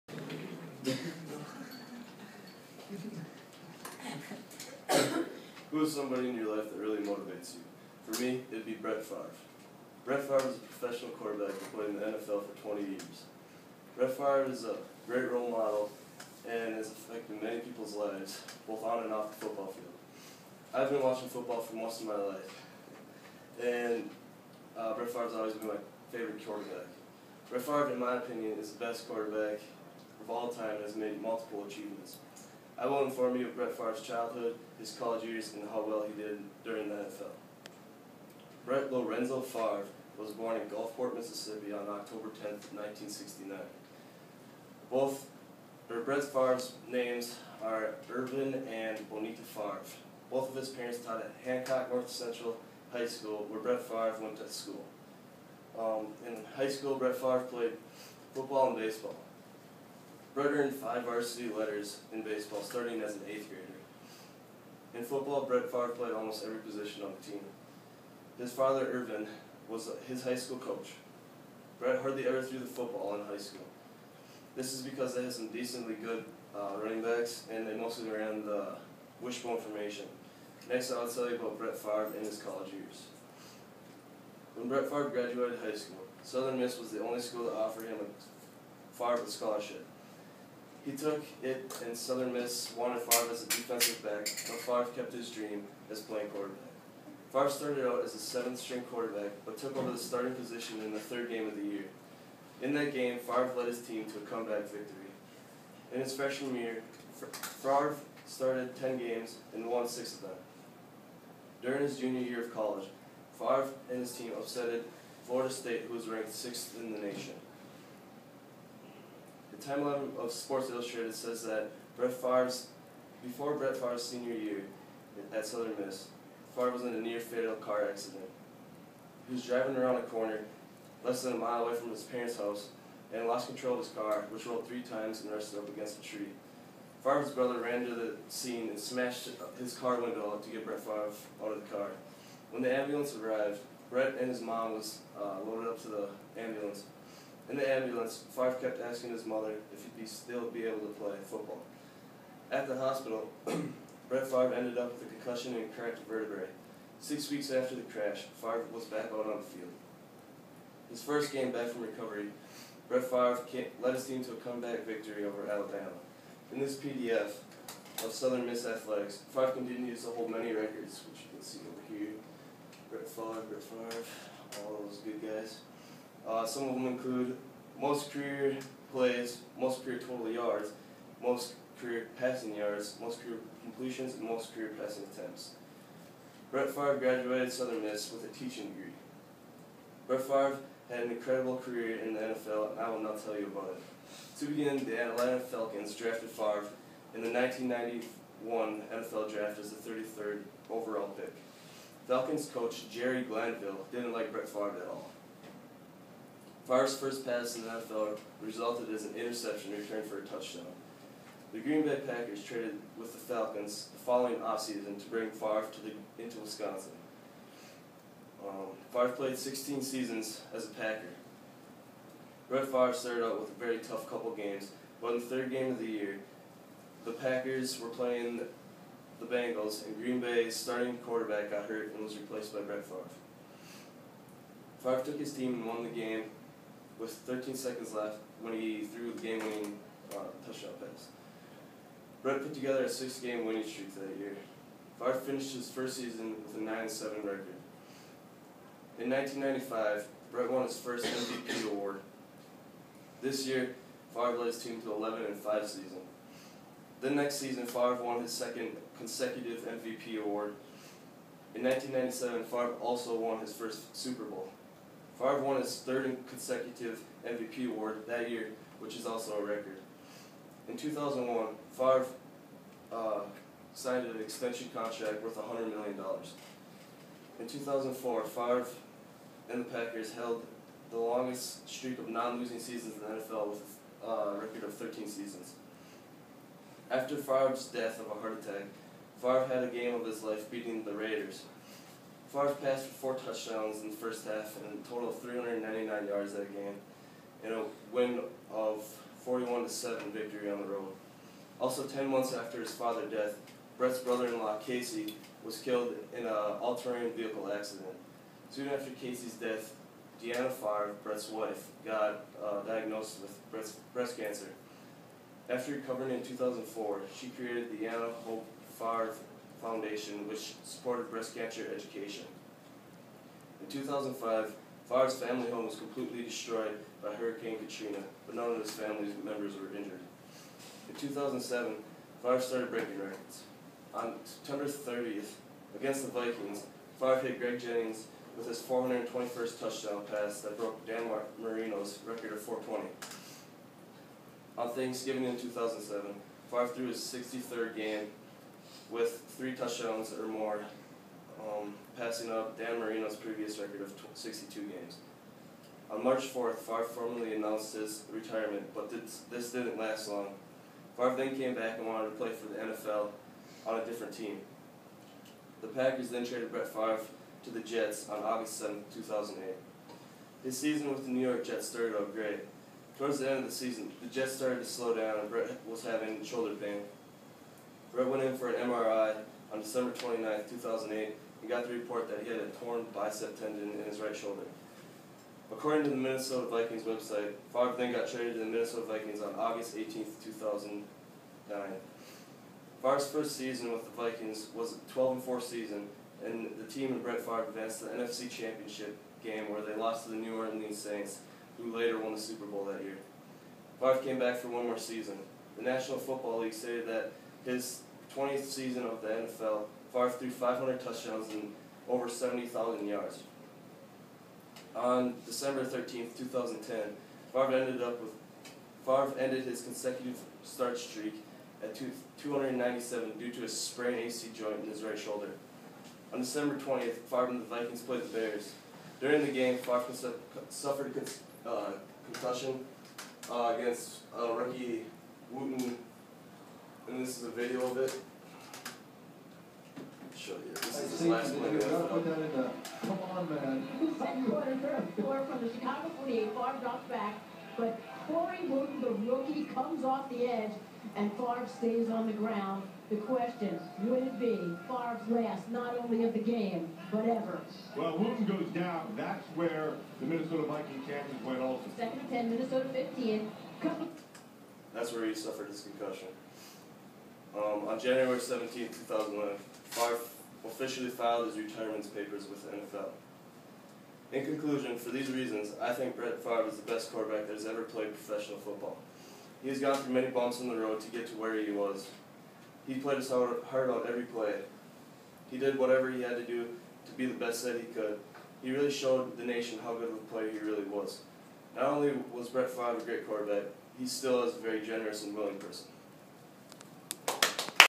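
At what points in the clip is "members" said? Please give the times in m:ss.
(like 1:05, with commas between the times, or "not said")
5:29.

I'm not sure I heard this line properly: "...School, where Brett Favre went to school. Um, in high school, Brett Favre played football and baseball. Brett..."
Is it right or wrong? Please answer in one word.
right.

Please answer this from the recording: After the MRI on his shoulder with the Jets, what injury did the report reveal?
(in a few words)
torn bicep tendon.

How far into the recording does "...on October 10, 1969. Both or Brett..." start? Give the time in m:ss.
0:41.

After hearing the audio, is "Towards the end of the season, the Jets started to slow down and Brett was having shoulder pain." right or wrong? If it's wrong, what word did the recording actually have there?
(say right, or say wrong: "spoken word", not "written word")
right.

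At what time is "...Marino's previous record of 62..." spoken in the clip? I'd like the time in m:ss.
5:52.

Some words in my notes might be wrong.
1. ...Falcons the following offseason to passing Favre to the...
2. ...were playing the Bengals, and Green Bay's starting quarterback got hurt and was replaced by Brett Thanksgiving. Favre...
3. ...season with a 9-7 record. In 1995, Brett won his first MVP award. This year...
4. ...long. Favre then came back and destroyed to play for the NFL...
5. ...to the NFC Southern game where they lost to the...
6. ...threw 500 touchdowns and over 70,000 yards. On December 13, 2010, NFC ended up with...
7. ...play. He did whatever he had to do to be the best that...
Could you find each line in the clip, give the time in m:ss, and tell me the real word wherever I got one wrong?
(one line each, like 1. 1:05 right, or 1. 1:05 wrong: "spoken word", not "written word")
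1. 3:33 wrong: "bring", not "passing"
2. 3:47 wrong: "Favre", not "Thanksgiving"
3. 4:05 right
4. 6:00 wrong: "wanted", not "destroyed"
5. 6:37 wrong: "Championship", not "Southern"
6. 6:50 wrong: "Favre", not "NFC"
7. 8:04 right.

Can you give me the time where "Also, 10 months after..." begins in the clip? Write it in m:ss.
5:01.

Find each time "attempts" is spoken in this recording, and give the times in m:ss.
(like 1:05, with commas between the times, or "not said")
3:05.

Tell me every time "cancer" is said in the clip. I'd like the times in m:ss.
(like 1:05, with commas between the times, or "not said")
5:14, 5:21.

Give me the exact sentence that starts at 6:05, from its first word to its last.
The Packers then traded Brett Favre to the Jets on August 7, 2008.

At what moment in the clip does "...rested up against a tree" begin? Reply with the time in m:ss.
2:15.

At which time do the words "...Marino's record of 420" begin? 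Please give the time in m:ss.
5:41.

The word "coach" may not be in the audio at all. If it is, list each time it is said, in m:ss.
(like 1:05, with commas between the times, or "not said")
1:10, 3:22.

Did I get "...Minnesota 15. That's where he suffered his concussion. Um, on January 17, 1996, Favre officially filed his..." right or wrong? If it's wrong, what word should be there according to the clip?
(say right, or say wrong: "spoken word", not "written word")
wrong: "2001", not "1996".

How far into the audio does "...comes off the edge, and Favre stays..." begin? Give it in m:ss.
7:29.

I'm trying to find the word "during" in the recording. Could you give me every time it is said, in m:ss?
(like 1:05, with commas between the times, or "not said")
0:36, 1:51, 7:08.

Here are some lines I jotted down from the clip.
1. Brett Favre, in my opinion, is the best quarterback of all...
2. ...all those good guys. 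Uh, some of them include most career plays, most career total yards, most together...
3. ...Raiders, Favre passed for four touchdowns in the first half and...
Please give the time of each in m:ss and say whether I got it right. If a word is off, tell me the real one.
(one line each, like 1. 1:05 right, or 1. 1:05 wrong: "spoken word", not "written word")
1. 0:27 right
2. 2:54 wrong: "career", not "together"
3. 4:50 right.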